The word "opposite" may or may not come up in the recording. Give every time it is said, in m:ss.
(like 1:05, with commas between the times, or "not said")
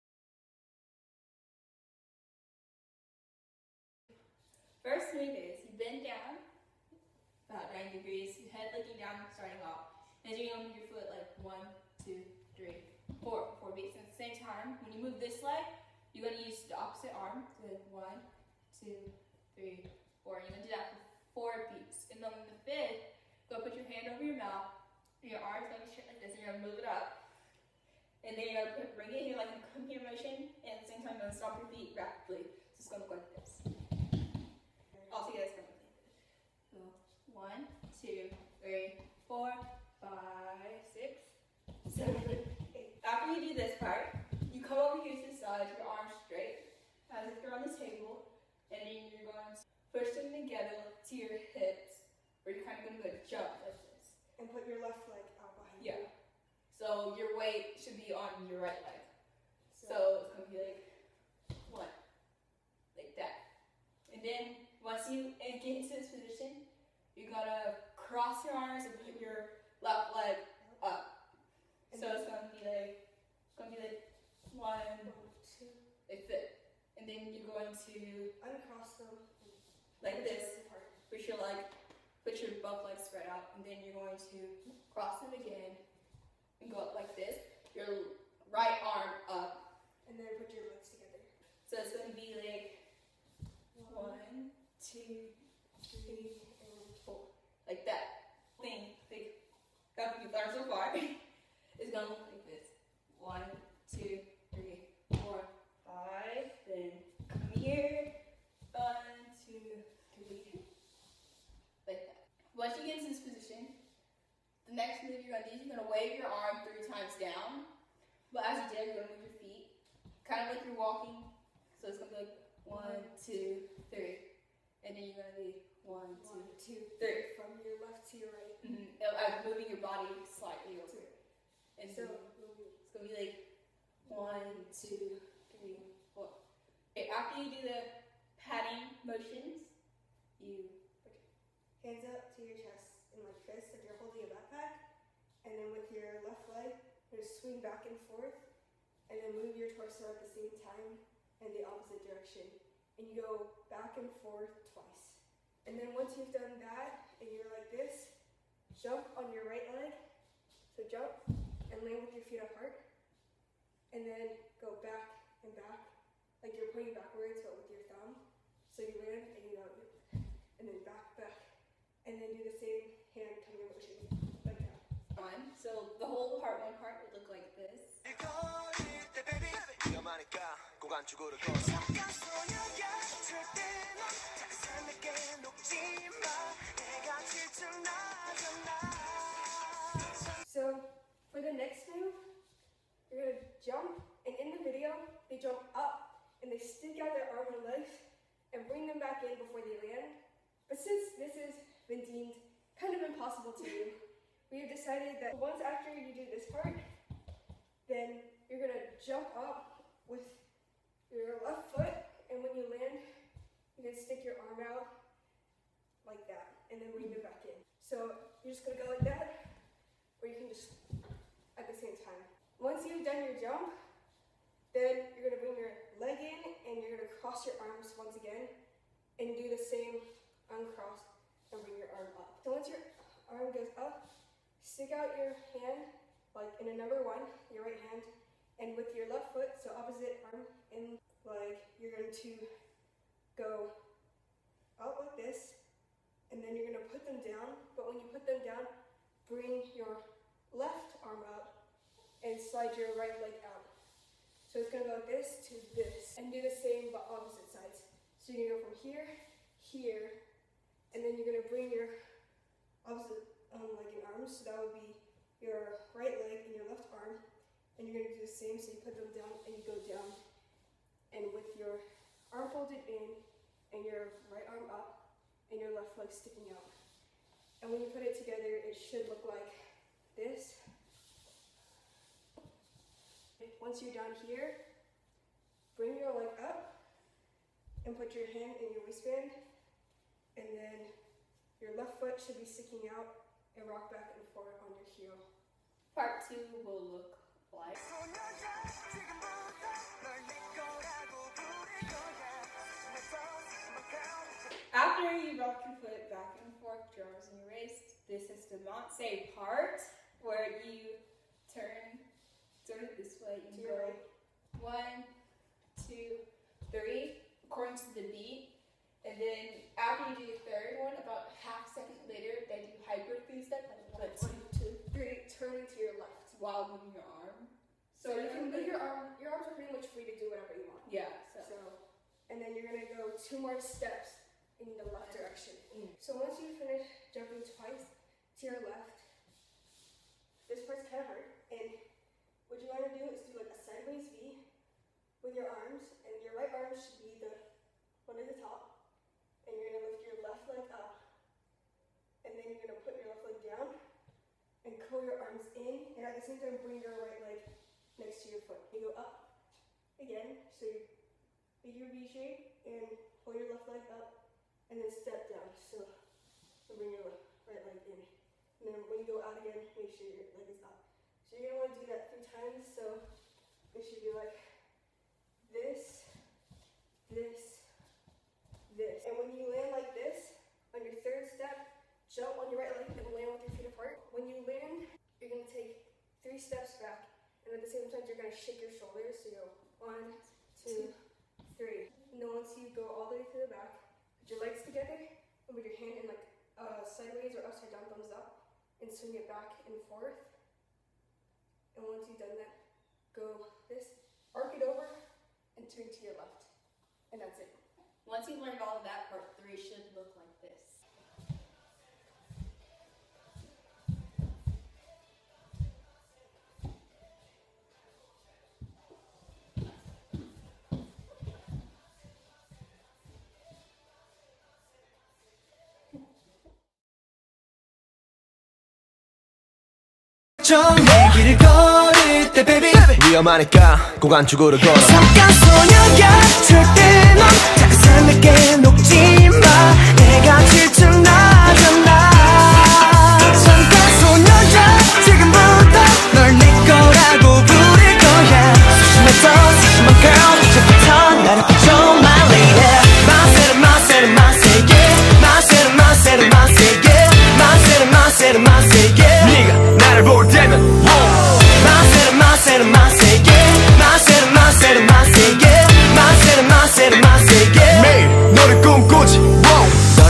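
0:16, 2:31, 3:59, 4:17, 4:22.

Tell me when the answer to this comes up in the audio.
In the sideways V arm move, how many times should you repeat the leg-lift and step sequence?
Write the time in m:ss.
6:12.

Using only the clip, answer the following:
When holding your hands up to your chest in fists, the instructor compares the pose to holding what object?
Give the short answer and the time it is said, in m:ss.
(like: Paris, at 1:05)
a backpack, at 2:24.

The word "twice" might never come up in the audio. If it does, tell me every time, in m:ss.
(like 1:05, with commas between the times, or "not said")
2:34, 5:37.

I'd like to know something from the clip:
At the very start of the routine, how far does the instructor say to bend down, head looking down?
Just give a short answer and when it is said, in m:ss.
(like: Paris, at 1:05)
90 degrees, at 0:07.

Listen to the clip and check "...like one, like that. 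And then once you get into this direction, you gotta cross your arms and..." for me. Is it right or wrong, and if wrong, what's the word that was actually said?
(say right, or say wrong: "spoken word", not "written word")
wrong: "position", not "direction".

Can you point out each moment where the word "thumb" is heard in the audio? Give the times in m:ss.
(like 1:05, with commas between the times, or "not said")
2:47, 6:37.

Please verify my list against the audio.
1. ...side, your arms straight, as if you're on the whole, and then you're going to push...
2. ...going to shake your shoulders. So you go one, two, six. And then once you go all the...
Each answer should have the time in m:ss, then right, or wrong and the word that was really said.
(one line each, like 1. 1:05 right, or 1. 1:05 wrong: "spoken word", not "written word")
1. 0:45 wrong: "table", not "whole"
2. 6:28 wrong: "three", not "six".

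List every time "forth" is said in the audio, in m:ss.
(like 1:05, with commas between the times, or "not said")
2:34, 4:54, 5:06, 6:39.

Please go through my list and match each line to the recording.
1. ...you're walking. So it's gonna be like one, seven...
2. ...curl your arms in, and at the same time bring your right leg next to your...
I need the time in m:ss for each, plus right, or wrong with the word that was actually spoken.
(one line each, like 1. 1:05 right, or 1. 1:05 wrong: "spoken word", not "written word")
1. 2:00 wrong: "two", not "seven"
2. 5:54 right.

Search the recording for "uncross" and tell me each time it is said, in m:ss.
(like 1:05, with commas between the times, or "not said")
1:18, 3:50.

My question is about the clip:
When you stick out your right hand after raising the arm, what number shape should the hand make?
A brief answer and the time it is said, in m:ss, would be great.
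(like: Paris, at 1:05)
1, at 3:56.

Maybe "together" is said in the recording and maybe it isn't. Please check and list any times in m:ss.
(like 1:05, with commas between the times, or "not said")
0:50, 1:30, 4:38, 6:34.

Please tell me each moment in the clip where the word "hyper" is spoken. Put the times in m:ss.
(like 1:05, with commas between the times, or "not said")
5:22.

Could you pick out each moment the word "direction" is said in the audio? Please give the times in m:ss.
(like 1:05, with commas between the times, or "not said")
2:32, 5:35.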